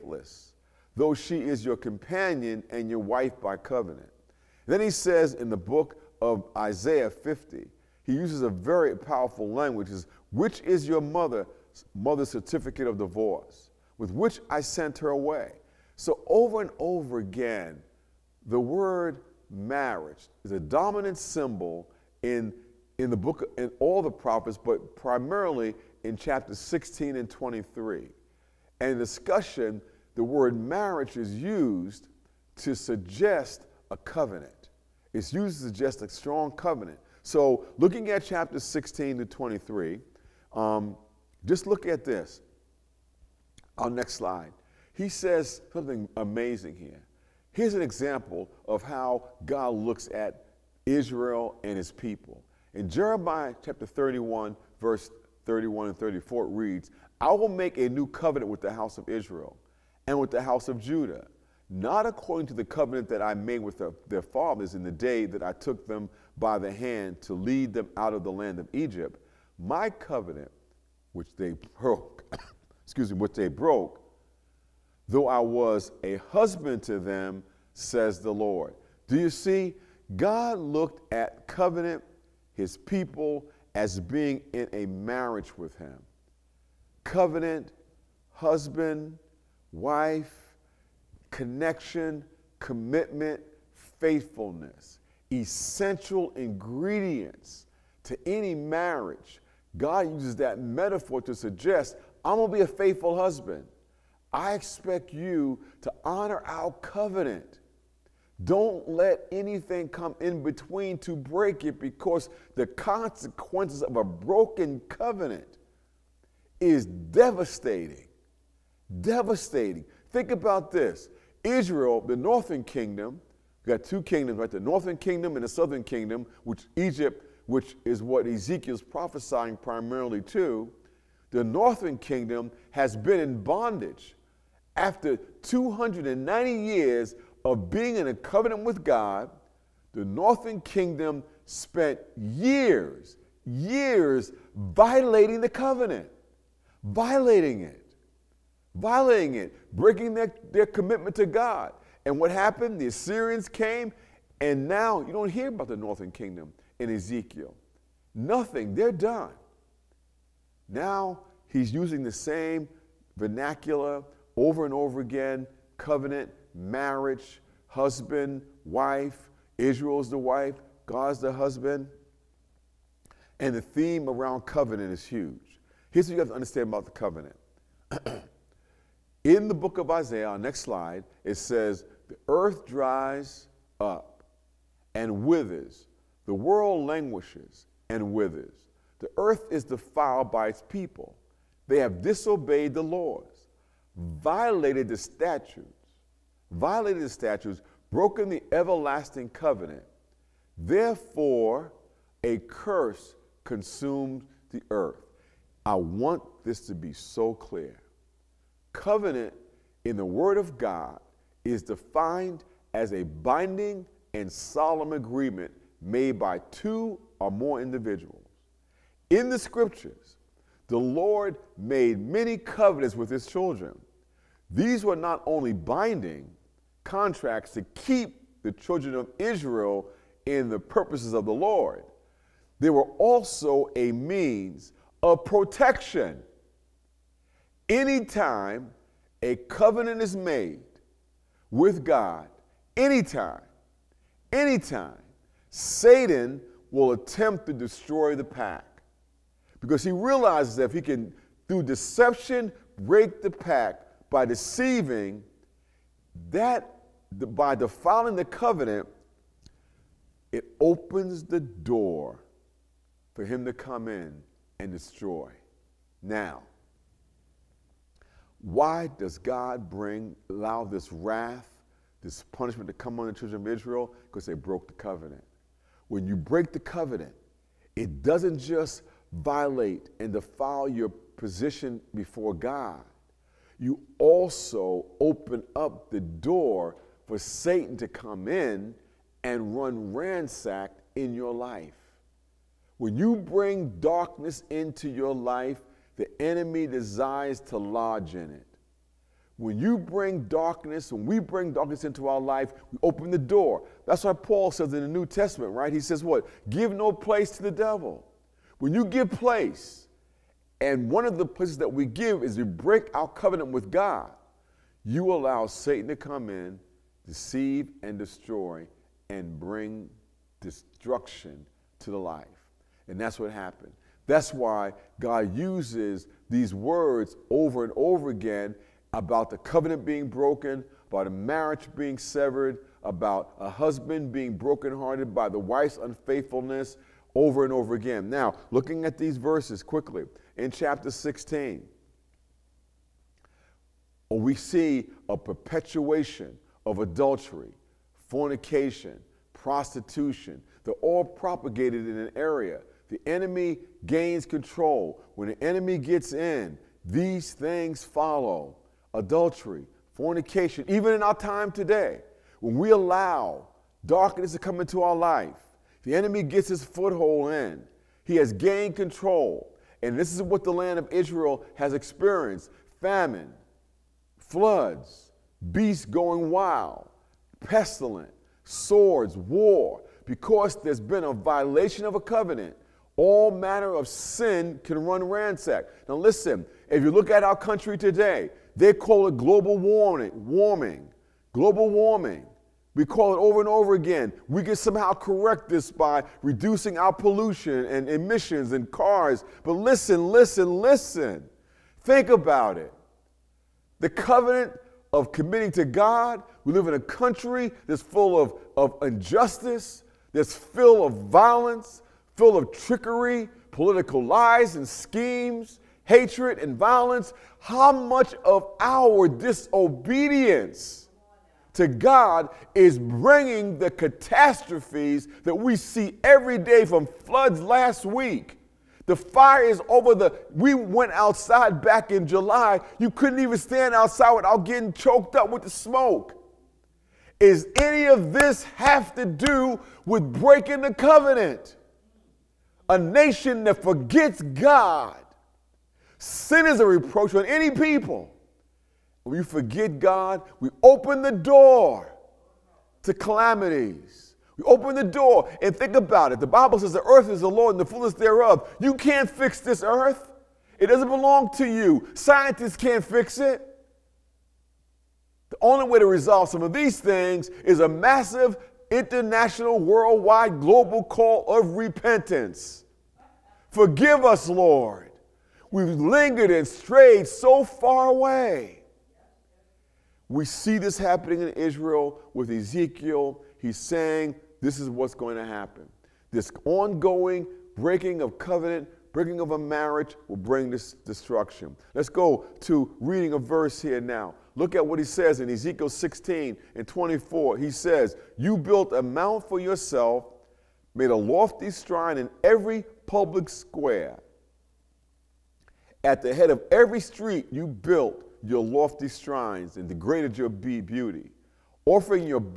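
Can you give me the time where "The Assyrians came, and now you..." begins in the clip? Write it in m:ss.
2:32.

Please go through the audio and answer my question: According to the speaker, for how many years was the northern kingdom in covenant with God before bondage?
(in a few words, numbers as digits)
290.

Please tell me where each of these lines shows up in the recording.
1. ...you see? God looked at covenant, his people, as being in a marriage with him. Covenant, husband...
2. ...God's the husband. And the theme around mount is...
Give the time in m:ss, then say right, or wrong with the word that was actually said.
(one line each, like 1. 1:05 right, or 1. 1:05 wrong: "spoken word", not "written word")
1. 1:19 right
2. 2:50 wrong: "covenant", not "mount".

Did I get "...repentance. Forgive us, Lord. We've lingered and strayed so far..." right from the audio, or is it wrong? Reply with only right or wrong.
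right.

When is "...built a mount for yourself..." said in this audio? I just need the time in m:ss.
8:18.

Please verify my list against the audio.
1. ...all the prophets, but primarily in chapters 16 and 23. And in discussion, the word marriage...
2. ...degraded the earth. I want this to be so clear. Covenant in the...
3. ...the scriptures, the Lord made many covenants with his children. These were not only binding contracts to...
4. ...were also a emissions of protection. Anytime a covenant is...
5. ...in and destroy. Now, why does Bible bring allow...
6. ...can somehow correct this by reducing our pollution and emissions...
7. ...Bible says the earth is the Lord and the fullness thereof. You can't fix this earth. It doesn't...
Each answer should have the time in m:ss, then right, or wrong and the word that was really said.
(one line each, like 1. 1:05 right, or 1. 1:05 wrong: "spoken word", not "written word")
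1. 0:23 right
2. 3:23 wrong: "consumed", not "degraded"
3. 3:39 right
4. 3:52 wrong: "means", not "emissions"
5. 4:23 wrong: "God", not "Bible"
6. 6:34 right
7. 7:36 right.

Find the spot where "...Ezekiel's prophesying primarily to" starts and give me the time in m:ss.
2:08.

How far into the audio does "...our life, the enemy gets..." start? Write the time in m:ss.
6:04.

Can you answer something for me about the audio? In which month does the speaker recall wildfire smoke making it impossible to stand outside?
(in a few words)
July.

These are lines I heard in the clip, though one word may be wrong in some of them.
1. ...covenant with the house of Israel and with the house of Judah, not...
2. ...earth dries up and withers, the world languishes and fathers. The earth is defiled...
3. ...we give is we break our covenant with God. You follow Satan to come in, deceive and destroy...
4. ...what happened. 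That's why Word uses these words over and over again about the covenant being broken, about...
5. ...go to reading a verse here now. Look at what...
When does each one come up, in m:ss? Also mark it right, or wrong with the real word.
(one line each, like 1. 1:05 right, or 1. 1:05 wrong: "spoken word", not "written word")
1. 0:58 right
2. 3:02 wrong: "withers", not "fathers"
3. 5:11 wrong: "allow", not "follow"
4. 5:23 wrong: "God", not "Word"
5. 8:11 right.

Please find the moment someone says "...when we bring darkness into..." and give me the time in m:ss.
5:00.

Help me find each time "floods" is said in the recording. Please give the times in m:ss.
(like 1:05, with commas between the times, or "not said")
6:14, 7:06.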